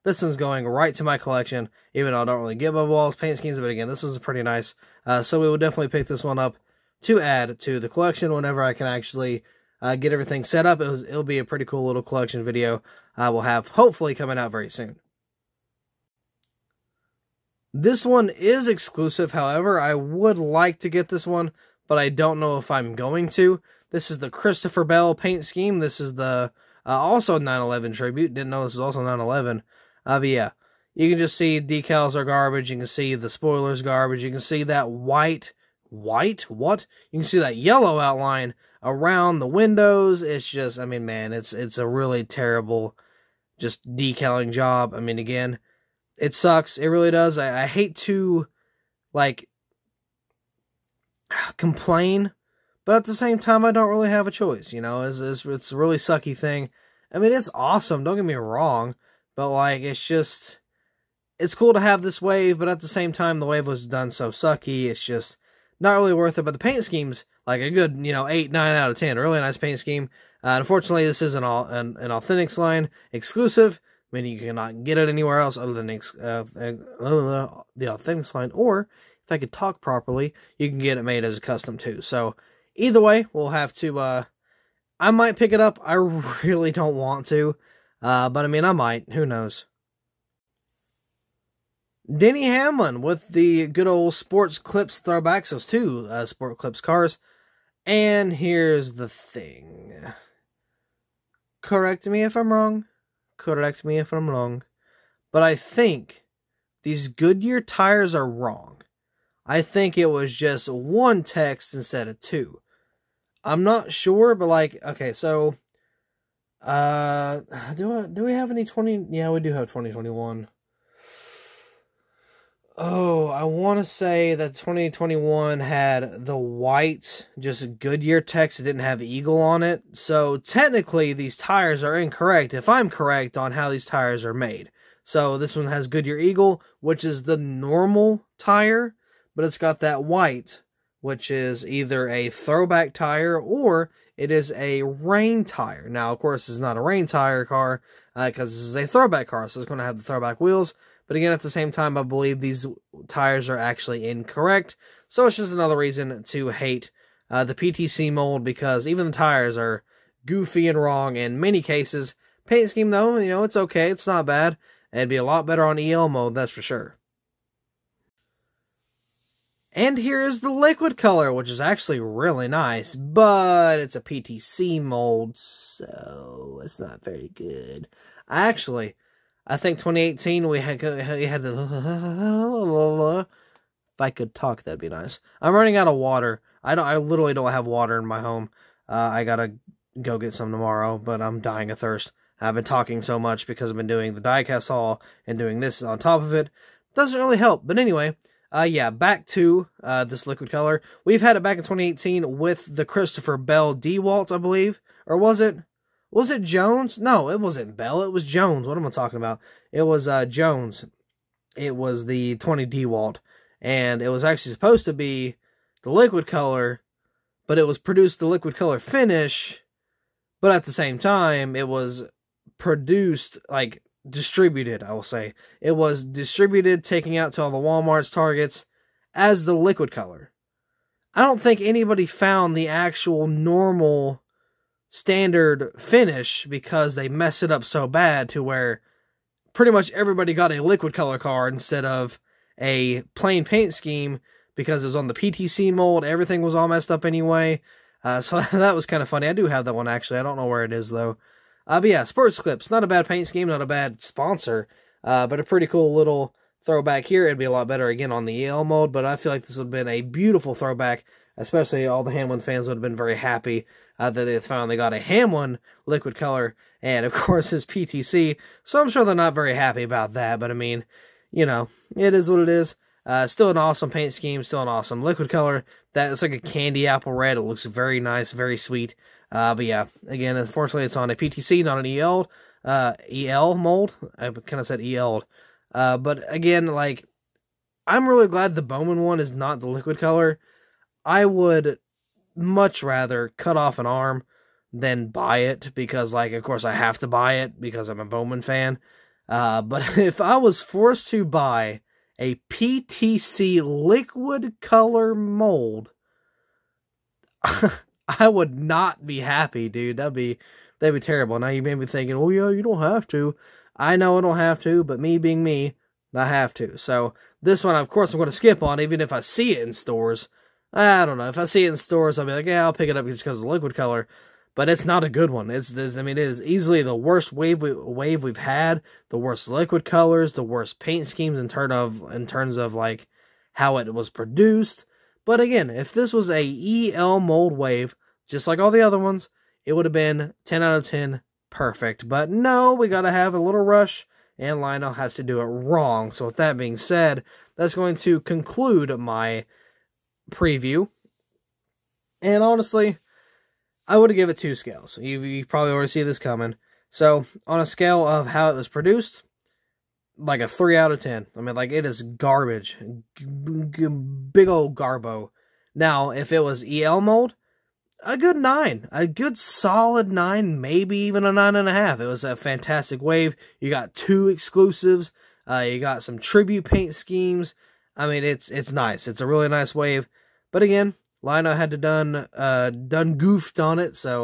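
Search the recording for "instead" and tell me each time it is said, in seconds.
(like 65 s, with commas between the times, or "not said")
111 s, 241 s.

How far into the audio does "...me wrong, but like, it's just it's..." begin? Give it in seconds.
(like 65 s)
58 s.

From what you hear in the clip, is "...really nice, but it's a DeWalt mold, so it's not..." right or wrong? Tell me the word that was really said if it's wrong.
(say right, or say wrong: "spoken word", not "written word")
wrong: "PTC", not "DeWalt".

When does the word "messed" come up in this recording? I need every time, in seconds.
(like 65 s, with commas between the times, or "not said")
237 s, 246 s.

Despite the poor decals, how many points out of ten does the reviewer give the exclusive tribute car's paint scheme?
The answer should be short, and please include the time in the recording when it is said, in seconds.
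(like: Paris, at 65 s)
8 or 9, at 68 s.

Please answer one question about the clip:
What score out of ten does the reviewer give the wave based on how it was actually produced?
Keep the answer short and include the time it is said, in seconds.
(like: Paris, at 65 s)
3, at 360 s.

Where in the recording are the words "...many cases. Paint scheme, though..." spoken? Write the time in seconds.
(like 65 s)
161 s.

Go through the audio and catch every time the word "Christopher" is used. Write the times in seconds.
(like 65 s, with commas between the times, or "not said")
24 s, 202 s.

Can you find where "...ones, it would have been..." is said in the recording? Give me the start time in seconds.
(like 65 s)
338 s.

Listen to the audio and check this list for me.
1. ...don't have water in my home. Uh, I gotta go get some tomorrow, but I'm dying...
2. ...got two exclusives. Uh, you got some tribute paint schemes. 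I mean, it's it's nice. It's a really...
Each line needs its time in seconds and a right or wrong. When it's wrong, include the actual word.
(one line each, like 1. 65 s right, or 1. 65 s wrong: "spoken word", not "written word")
1. 187 s right
2. 373 s right.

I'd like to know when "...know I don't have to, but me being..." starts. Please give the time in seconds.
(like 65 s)
313 s.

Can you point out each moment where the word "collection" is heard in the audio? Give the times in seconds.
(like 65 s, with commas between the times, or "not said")
1 s, 7 s, 12 s.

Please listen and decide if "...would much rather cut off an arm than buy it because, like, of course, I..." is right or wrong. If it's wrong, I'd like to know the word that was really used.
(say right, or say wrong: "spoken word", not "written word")
right.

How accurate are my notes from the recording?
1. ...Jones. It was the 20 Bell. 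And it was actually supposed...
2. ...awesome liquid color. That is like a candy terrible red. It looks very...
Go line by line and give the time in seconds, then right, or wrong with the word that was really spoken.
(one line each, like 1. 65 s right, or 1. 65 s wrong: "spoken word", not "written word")
1. 210 s wrong: "DeWalt", not "Bell"
2. 274 s wrong: "apple", not "terrible".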